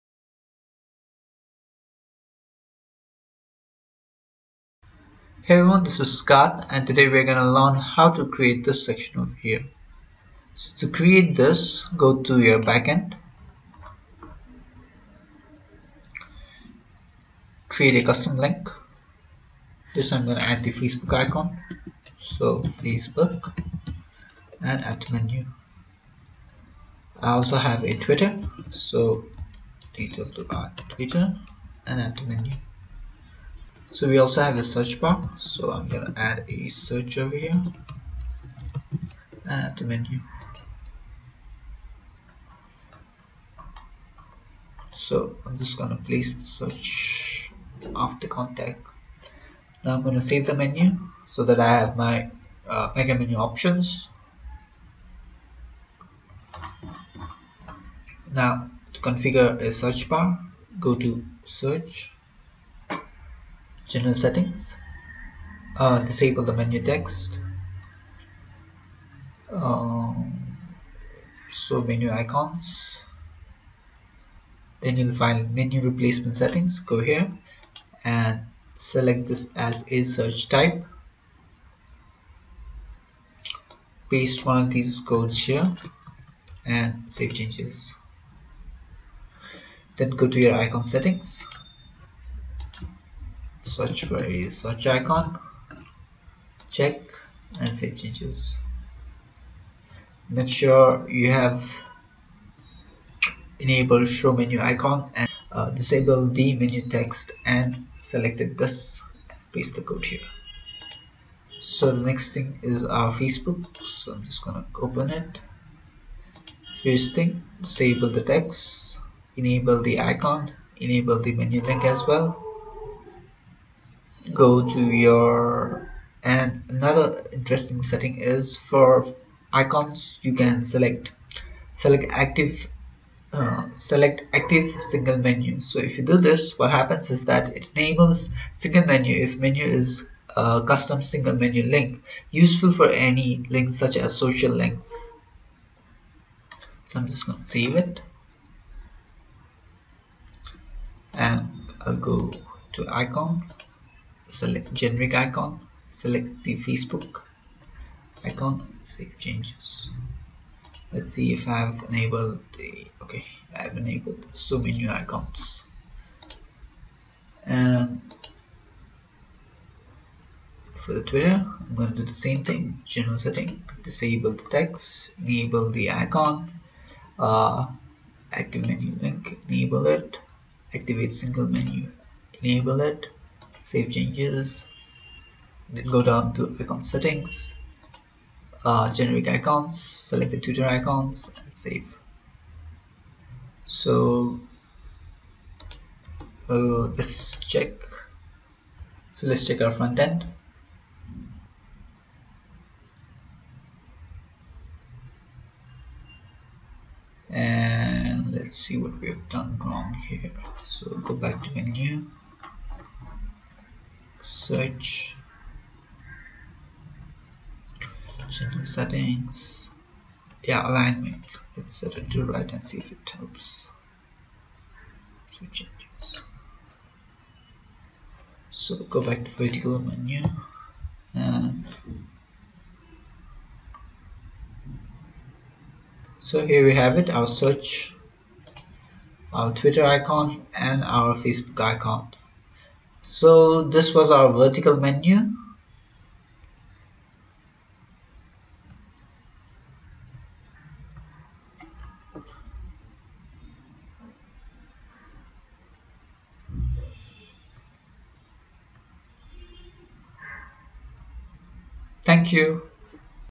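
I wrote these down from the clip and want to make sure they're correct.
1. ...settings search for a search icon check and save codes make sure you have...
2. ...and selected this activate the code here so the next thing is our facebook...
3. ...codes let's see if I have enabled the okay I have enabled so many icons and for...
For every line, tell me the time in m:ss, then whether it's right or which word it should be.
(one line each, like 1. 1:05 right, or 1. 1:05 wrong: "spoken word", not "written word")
1. 1:30 wrong: "changes", not "codes"
2. 1:47 wrong: "paste", not "activate"
3. 2:39 wrong: "changes", not "codes".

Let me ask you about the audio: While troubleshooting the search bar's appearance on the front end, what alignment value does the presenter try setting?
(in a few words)
Right.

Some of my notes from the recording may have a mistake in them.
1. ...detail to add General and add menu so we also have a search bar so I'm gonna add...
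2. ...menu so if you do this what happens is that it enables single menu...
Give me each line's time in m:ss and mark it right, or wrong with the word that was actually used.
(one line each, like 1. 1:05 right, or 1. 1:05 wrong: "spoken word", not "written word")
1. 0:29 wrong: "Twitter", not "General"
2. 2:15 right.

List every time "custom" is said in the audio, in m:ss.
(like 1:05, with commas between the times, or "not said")
0:18, 2:20.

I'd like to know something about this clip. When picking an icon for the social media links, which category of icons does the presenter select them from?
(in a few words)
Generic icons.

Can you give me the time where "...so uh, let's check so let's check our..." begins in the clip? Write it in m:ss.
3:13.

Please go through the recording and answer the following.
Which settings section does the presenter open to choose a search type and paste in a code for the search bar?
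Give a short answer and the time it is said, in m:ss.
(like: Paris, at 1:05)
Menu replacement settings, at 1:15.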